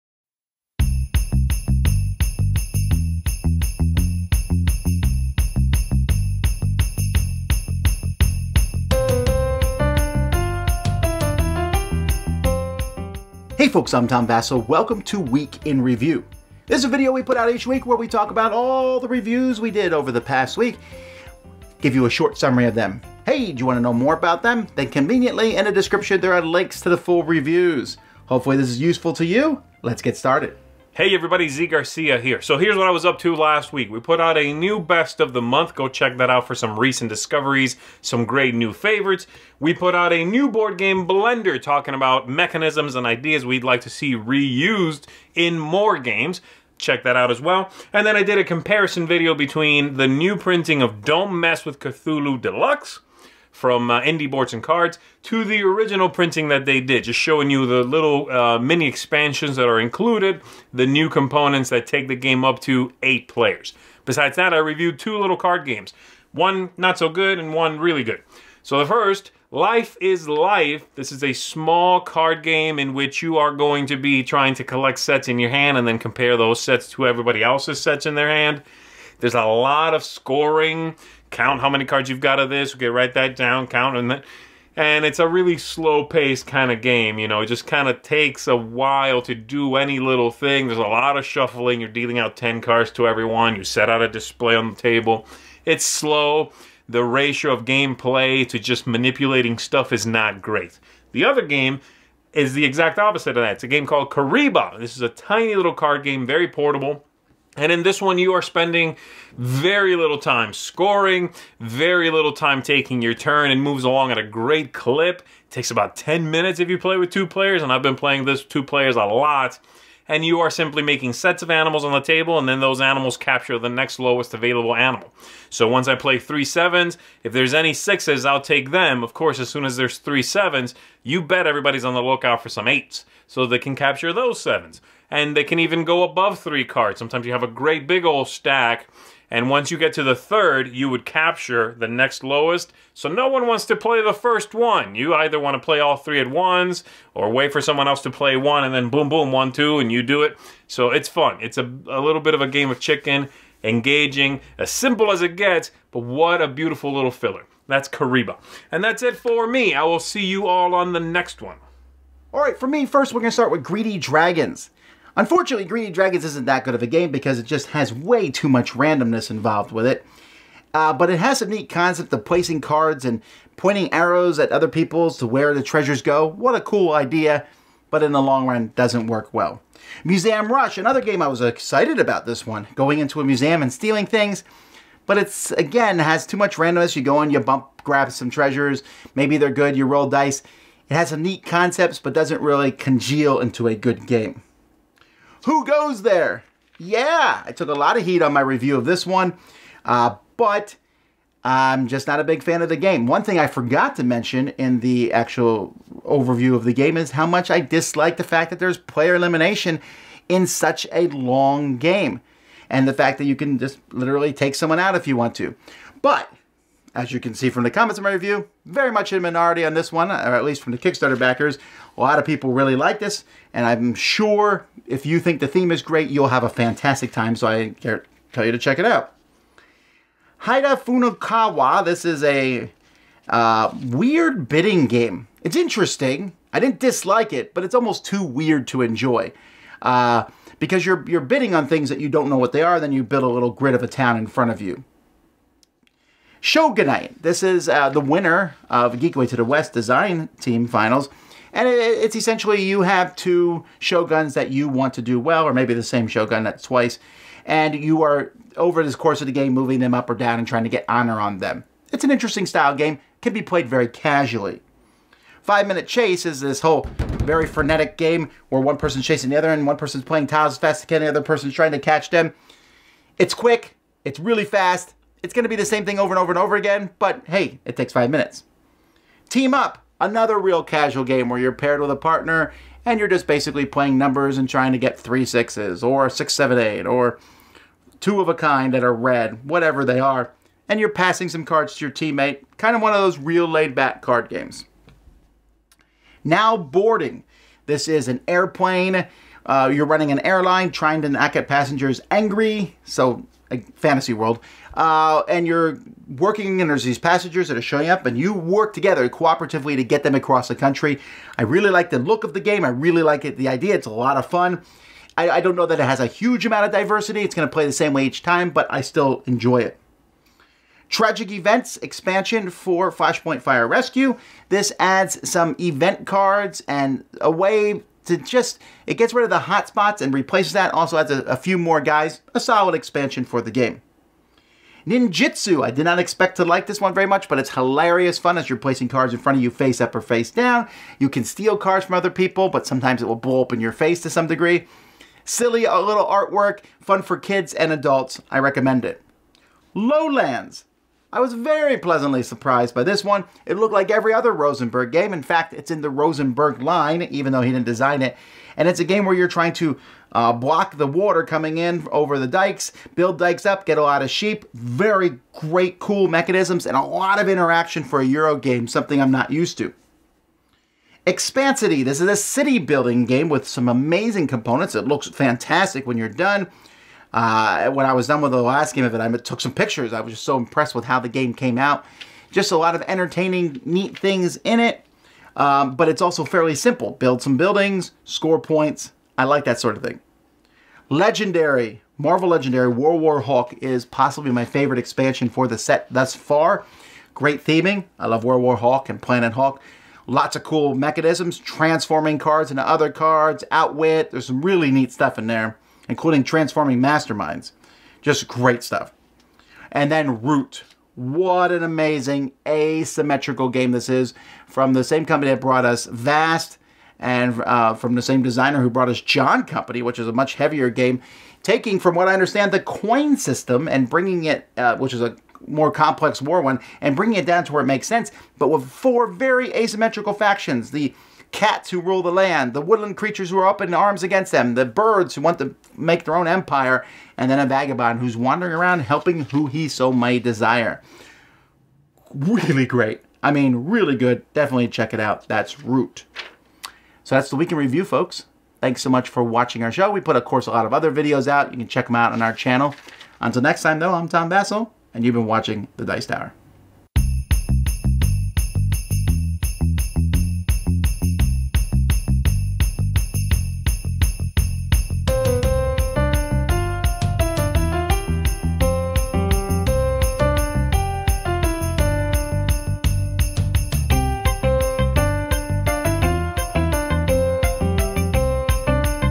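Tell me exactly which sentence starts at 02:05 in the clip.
So once I play three sevens, if there's any sixes, I'll take them.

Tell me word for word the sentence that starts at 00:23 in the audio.
Hey, do you want to know more about them?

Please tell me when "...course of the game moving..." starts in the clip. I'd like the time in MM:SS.
04:18.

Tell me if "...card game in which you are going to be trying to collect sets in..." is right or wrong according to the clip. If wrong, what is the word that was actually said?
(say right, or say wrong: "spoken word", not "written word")
right.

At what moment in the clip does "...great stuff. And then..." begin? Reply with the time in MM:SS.
06:48.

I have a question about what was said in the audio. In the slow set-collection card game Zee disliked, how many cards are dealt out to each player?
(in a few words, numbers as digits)
10.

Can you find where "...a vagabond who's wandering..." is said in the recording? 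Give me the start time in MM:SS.
07:17.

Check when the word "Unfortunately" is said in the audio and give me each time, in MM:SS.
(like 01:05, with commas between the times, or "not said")
02:45.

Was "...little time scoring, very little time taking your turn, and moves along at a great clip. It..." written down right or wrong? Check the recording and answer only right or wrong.
right.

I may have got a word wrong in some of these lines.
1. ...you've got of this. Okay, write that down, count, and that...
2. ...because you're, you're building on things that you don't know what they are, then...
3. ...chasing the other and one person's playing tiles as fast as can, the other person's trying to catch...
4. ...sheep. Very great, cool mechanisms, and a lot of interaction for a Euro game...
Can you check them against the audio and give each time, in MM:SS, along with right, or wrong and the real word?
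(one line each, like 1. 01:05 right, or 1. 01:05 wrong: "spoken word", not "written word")
1. 01:22 right
2. 04:00 wrong: "bidding", not "building"
3. 04:29 right
4. 06:04 right.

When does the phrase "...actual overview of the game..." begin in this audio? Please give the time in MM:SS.
03:25.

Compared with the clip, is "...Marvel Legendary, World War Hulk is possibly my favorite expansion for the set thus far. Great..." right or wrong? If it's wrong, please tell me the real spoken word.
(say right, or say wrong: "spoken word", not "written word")
right.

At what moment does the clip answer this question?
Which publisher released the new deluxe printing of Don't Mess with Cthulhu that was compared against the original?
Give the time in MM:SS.
00:54.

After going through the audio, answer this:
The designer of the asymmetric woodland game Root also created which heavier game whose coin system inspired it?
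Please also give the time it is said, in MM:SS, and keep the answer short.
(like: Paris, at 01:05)
John Company, at 06:59.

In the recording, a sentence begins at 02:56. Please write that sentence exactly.
What a cool idea, but in the long run, doesn't work well.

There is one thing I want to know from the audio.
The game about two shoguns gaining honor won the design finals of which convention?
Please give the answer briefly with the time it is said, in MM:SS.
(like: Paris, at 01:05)
Geekway to the West, at 04:08.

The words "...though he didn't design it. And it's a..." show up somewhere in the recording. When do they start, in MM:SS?
05:57.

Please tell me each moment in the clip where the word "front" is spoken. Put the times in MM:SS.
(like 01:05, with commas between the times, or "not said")
04:04, 05:39.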